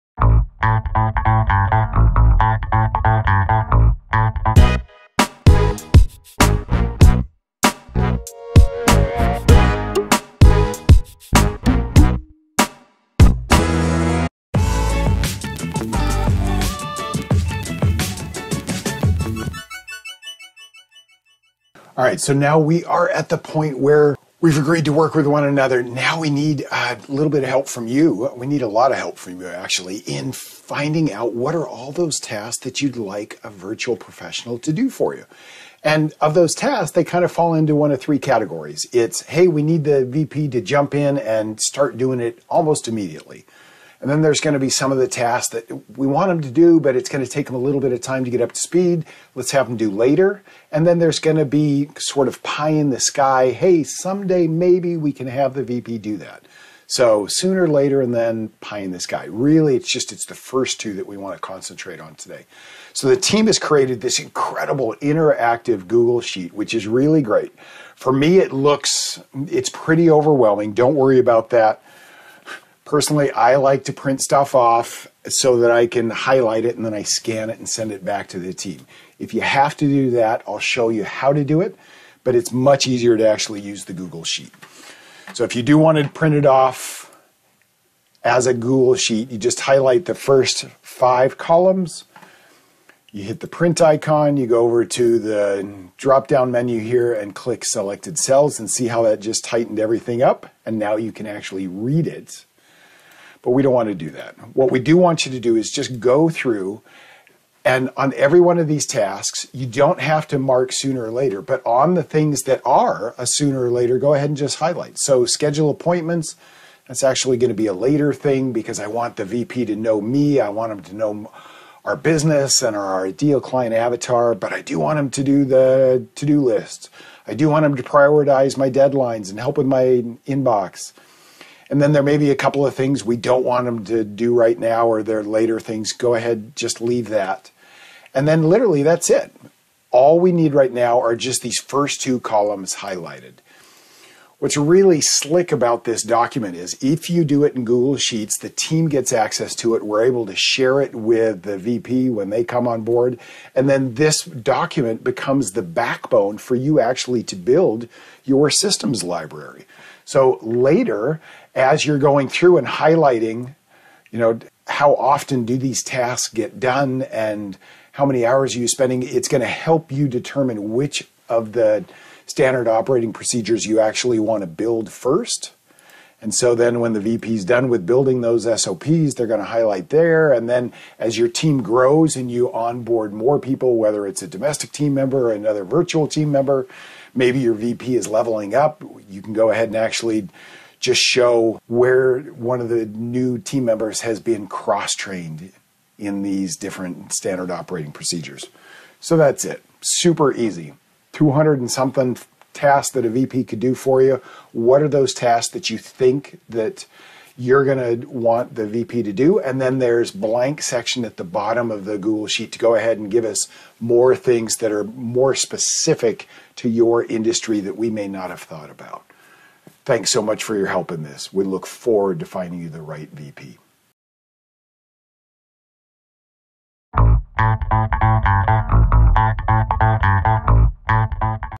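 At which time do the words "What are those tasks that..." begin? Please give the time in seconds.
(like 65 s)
204 s.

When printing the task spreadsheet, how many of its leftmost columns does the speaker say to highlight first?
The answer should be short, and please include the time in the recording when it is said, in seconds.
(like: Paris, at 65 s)
5, at 90 s.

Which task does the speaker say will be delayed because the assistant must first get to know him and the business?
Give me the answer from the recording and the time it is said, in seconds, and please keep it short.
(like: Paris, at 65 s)
Schedule appointments, at 115 s.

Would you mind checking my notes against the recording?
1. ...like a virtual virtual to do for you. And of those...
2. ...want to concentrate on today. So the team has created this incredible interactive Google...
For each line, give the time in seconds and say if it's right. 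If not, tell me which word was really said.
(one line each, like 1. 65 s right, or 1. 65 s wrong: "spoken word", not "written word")
1. 32 s wrong: "professional", not "virtual"
2. 61 s right.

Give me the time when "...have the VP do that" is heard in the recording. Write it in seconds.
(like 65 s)
55 s.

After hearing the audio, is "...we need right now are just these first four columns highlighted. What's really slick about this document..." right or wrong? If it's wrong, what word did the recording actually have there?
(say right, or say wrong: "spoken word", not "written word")
wrong: "two", not "four".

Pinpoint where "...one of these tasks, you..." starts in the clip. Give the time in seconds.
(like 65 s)
108 s.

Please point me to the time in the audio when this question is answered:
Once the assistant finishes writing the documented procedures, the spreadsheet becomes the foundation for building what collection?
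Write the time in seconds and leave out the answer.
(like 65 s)
158 s.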